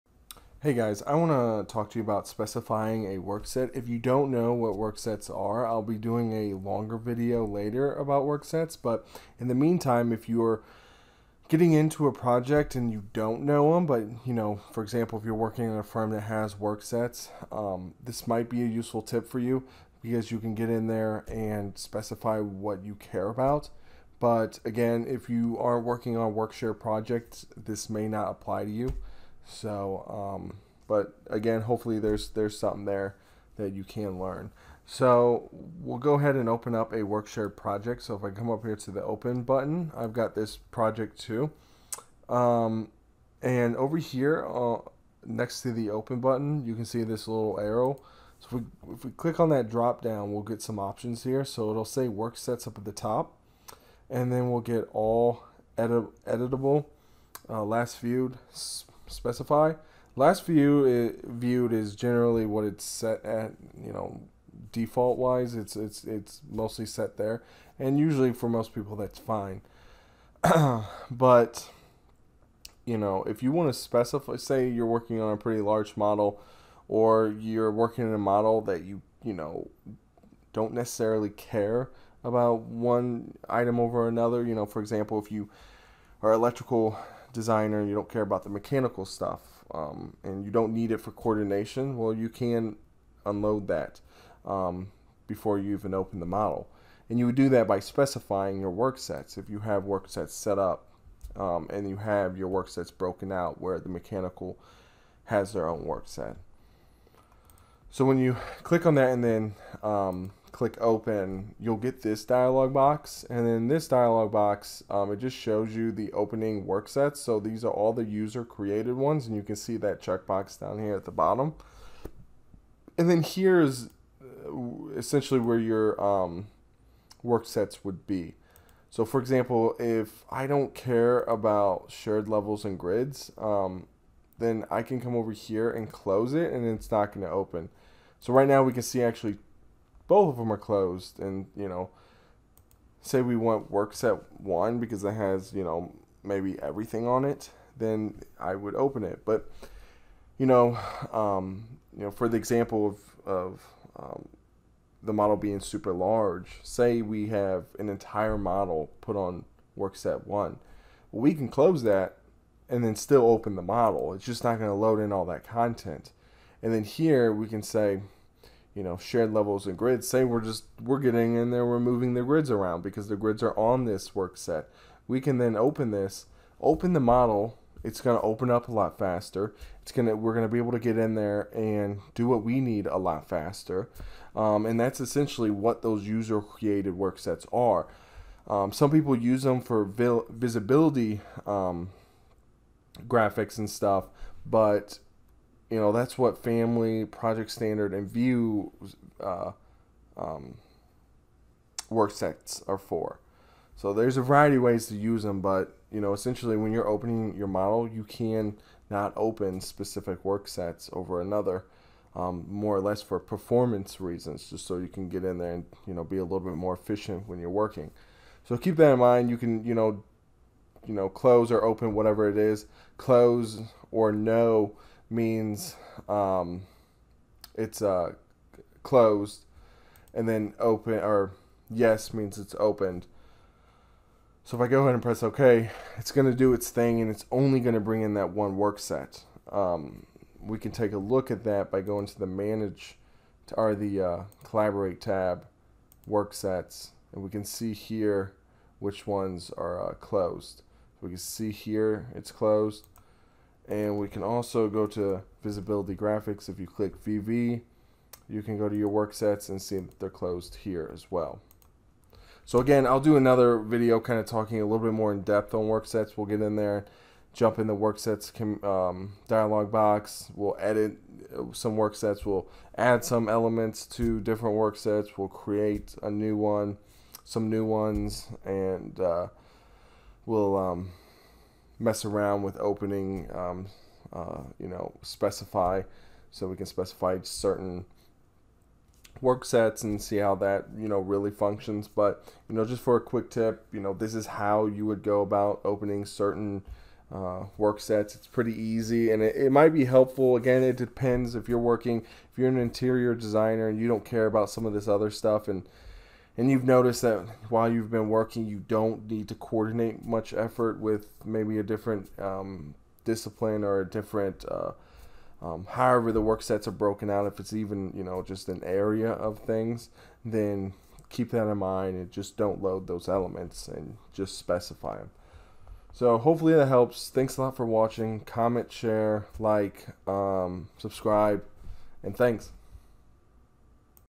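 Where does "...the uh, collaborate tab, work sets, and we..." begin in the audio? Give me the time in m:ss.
4:03.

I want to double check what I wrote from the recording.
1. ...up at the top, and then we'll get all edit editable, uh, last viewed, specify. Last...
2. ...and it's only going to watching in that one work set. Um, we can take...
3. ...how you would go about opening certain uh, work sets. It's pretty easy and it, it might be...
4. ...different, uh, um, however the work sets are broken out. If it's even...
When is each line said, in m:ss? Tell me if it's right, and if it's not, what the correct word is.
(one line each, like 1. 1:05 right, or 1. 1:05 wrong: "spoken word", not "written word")
1. 0:52 right
2. 3:57 wrong: "bring", not "watching"
3. 4:54 right
4. 5:13 right.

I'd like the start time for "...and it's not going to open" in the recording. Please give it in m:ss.
2:16.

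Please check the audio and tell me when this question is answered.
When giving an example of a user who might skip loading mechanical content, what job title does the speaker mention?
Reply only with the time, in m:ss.
1:26.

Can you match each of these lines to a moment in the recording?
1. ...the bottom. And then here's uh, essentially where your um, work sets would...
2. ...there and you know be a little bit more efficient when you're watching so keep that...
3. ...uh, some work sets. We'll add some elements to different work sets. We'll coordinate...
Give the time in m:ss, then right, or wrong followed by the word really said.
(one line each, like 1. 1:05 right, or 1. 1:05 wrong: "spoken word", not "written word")
1. 2:01 right
2. 3:35 wrong: "working", not "watching"
3. 4:31 wrong: "create", not "coordinate".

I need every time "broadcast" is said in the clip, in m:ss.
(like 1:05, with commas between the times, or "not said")
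not said.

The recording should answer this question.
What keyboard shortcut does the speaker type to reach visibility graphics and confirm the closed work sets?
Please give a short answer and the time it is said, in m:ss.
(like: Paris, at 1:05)
VV, at 4:16.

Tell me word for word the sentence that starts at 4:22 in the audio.
So again, I'll do another video kind of talking a little bit more in depth on work sets.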